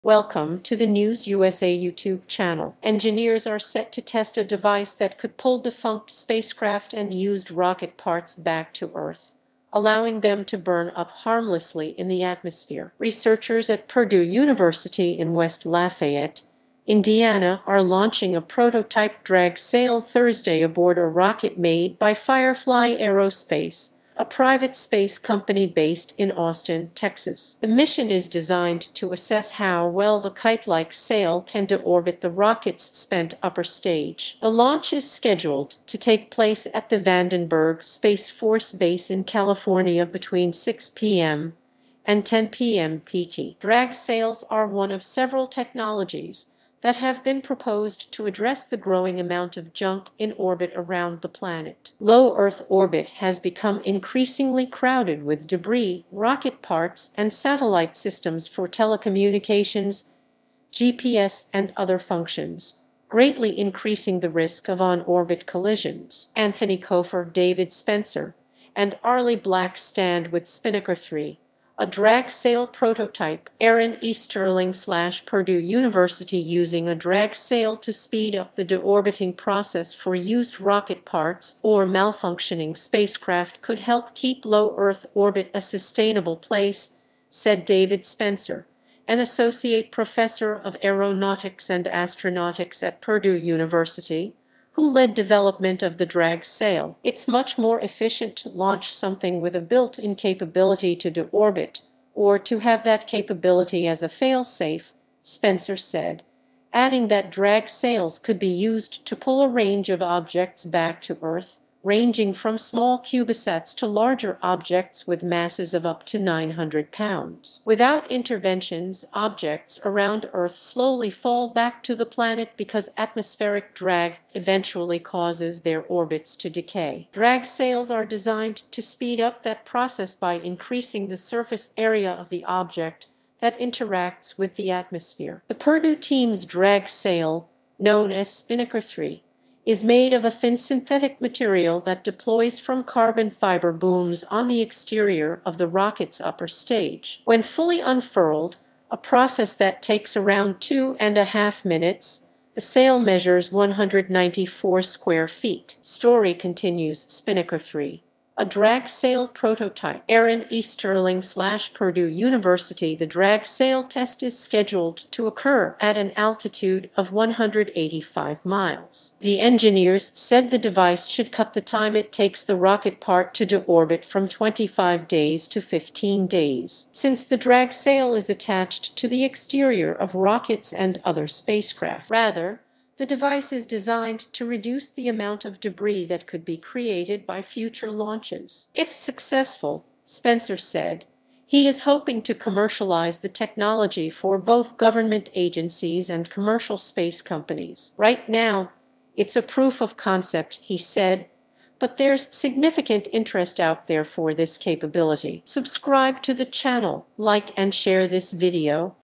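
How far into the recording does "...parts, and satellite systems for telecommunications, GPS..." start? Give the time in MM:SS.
00:56.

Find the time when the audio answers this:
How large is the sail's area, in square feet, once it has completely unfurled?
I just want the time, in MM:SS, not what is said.
02:33.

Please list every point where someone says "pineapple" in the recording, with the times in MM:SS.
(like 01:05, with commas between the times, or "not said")
not said.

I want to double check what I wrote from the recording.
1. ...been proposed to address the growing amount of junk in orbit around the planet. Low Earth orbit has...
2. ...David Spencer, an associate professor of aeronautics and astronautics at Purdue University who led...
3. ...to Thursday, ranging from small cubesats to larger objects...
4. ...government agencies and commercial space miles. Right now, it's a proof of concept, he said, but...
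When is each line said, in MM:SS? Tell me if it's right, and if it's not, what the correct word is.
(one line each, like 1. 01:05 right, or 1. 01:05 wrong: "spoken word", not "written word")
1. 00:47 right
2. 01:27 right
3. 01:51 wrong: "Earth", not "Thursday"
4. 03:14 wrong: "companies", not "miles".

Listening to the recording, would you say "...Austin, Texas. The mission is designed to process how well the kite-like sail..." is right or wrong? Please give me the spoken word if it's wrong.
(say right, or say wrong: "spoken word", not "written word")
wrong: "assess", not "process".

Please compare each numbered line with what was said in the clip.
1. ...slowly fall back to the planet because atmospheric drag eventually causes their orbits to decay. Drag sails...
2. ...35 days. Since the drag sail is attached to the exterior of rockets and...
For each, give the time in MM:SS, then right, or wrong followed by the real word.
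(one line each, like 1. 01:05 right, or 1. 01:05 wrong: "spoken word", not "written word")
1. 02:00 right
2. 02:55 wrong: "15", not "35".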